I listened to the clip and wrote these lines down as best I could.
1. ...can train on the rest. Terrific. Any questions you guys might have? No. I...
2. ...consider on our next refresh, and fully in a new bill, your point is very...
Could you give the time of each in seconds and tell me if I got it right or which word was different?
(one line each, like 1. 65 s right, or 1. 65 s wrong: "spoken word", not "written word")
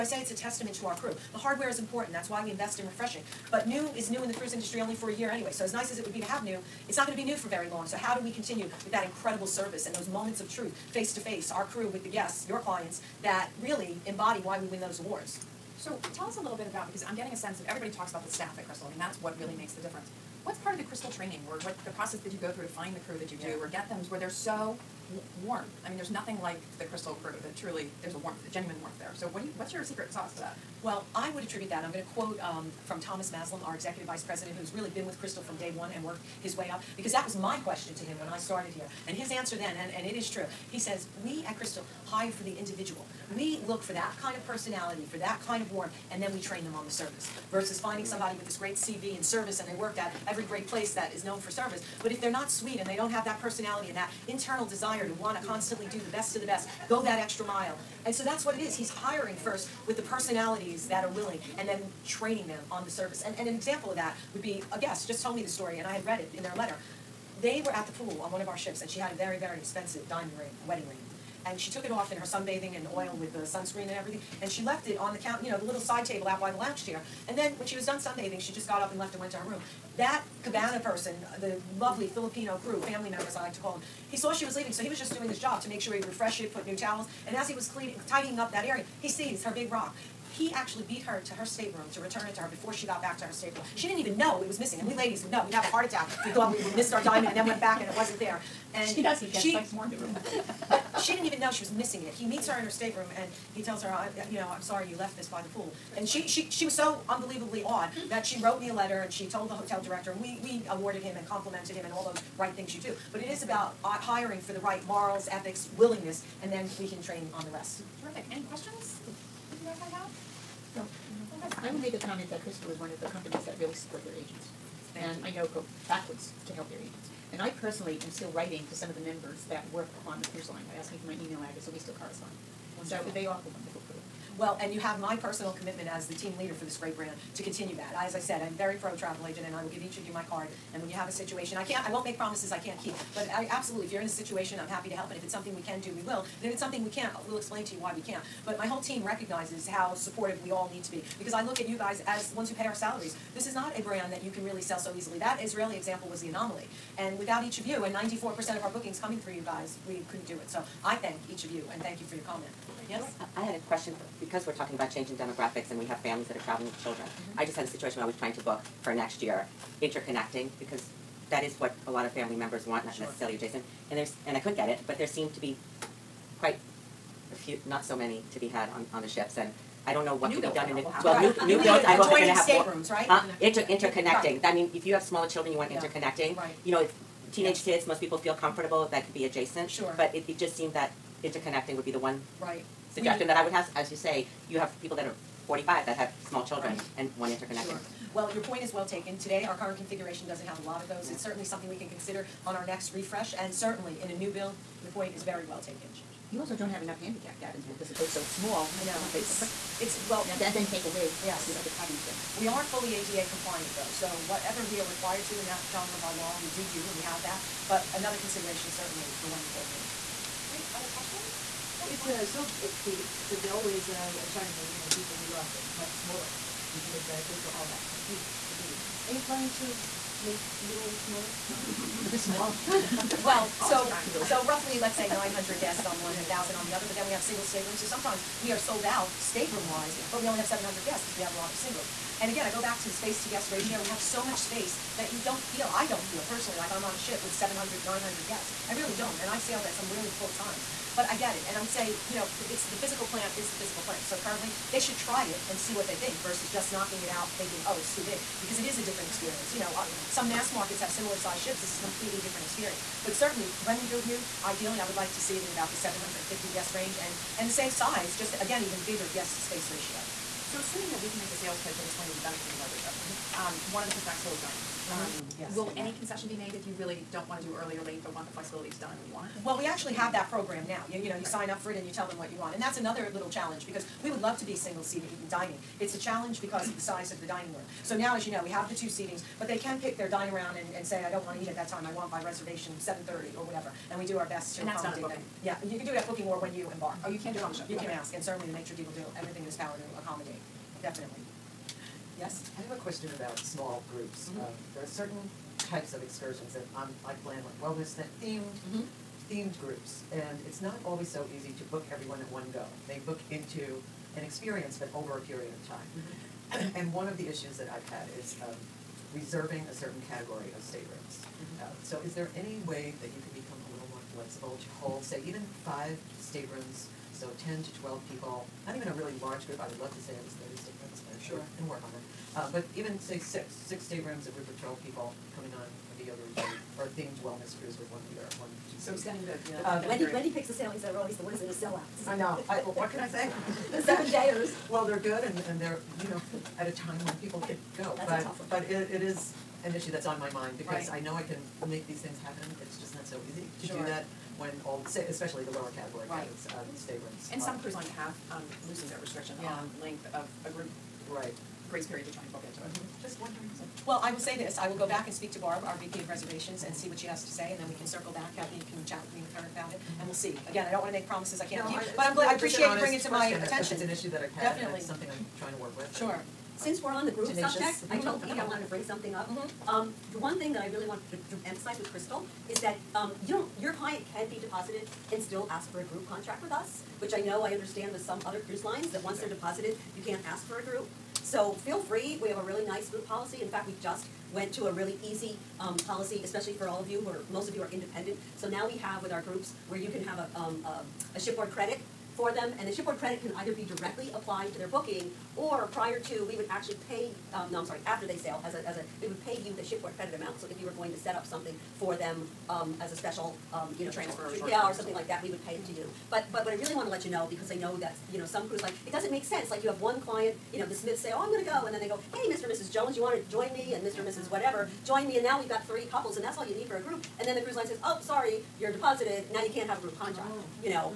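1. 116 s right
2. 201 s wrong: "certainly", not "fully".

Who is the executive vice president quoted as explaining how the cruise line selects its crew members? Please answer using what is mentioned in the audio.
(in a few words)
Thomas Mazloum.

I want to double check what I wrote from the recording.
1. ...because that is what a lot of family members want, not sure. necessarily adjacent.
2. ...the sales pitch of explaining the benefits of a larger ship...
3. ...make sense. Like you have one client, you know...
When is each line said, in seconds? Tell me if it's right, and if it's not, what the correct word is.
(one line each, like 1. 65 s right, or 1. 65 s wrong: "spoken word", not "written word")
1. 170 s right
2. 271 s right
3. 419 s right.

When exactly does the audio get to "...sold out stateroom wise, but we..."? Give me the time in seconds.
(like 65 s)
238 s.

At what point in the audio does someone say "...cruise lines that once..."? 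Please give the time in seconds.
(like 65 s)
388 s.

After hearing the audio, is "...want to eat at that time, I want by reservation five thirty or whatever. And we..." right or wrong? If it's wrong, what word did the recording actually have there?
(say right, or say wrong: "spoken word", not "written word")
wrong: "seven", not "five".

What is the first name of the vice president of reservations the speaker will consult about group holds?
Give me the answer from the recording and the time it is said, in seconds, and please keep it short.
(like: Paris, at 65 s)
Barb, at 365 s.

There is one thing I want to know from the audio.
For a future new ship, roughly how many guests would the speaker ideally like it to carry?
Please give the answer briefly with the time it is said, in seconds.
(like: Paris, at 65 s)
750, at 265 s.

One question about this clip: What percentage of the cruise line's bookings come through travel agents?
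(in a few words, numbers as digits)
94%.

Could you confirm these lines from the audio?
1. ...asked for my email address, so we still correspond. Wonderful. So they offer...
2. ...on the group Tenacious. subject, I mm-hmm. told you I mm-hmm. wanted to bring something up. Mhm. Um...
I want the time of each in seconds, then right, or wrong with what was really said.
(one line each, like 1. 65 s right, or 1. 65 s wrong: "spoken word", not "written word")
1. 130 s right
2. 376 s right.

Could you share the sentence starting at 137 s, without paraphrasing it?
I, as I said, I'm very pro travel agent, and I will give each of you my card.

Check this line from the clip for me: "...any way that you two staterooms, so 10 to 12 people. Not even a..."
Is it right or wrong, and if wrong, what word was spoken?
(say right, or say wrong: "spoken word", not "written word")
wrong: "five", not "two".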